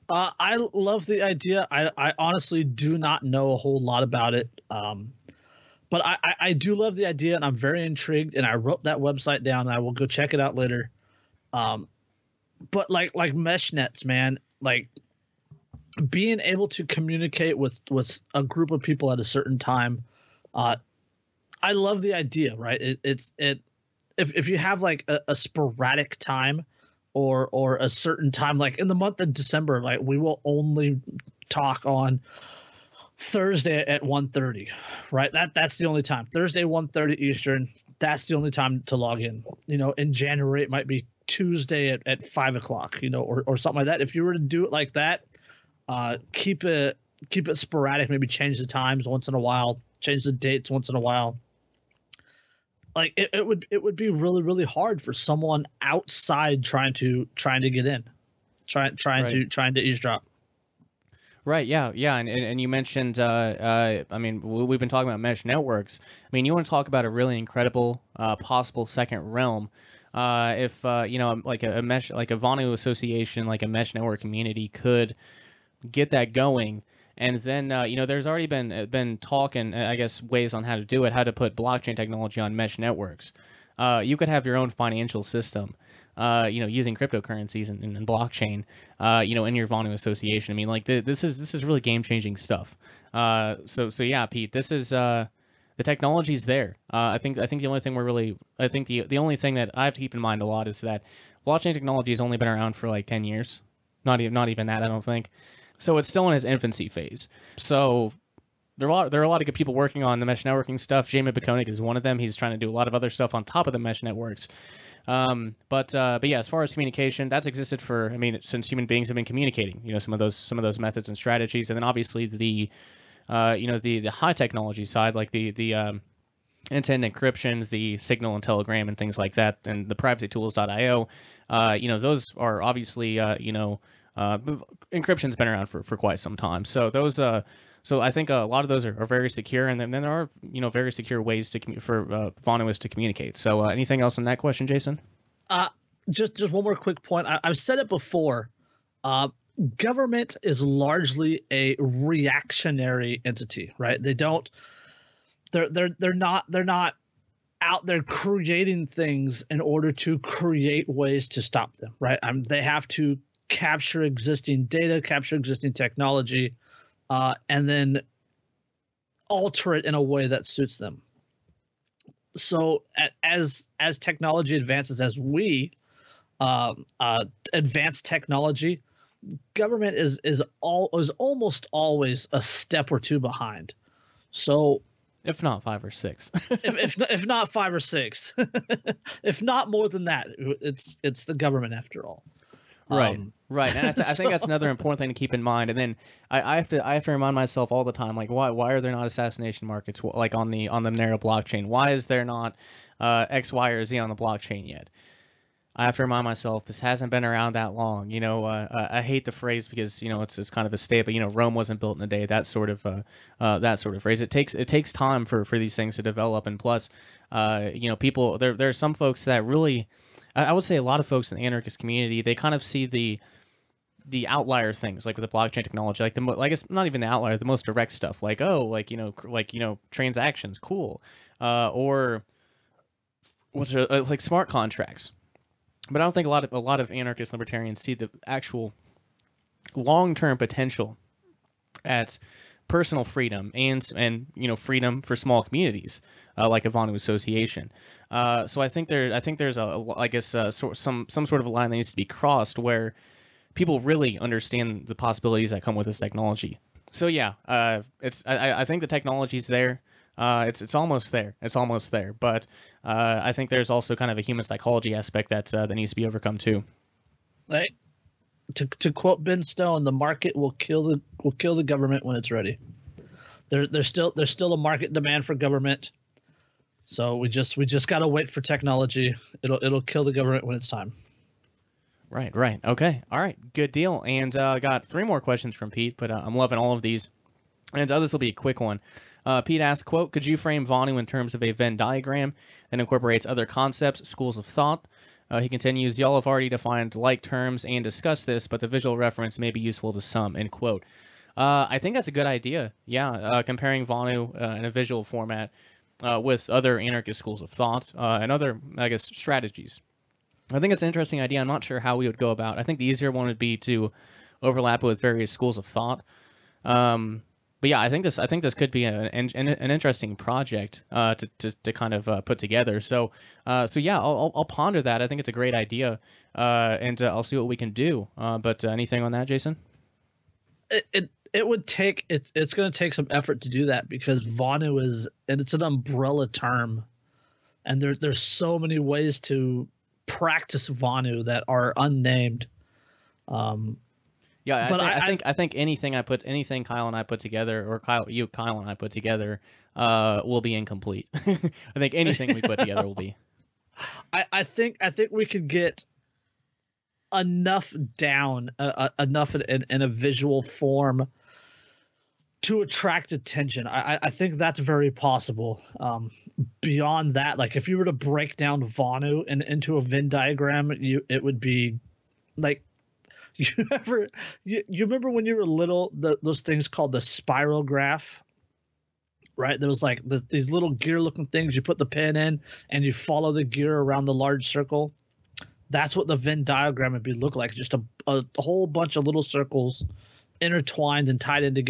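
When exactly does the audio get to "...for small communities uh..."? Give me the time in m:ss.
4:05.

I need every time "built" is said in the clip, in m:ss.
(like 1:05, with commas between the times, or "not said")
3:31.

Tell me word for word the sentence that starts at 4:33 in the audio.
There there's still there's still a market demand for government.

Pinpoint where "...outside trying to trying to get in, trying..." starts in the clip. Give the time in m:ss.
0:55.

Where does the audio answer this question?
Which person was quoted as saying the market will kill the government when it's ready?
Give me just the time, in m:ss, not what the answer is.
4:29.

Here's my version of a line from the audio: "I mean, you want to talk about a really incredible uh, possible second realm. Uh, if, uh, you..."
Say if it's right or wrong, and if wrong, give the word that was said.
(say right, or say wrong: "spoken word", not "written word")
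right.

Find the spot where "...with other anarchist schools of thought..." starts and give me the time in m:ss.
5:06.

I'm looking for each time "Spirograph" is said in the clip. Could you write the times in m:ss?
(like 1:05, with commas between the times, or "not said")
6:16.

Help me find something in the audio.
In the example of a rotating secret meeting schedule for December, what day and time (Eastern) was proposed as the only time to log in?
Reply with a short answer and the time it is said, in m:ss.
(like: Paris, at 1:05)
Thursday 1:30, at 0:36.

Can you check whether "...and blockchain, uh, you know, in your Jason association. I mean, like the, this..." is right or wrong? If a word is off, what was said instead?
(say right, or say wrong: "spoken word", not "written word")
wrong: "Vonu", not "Jason".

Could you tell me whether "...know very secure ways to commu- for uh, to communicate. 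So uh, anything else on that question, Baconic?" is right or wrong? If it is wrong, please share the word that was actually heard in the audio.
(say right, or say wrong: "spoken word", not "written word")
wrong: "Jason", not "Baconic".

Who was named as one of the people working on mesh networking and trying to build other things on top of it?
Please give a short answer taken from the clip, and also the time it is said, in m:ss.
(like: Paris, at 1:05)
Jamie Baconic, at 1:51.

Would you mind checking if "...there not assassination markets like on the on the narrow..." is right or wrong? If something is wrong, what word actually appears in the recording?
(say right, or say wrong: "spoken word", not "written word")
right.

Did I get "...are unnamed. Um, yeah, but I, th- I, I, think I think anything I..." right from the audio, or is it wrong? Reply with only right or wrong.
right.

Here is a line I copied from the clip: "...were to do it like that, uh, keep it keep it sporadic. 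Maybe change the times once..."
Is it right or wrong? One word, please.
right.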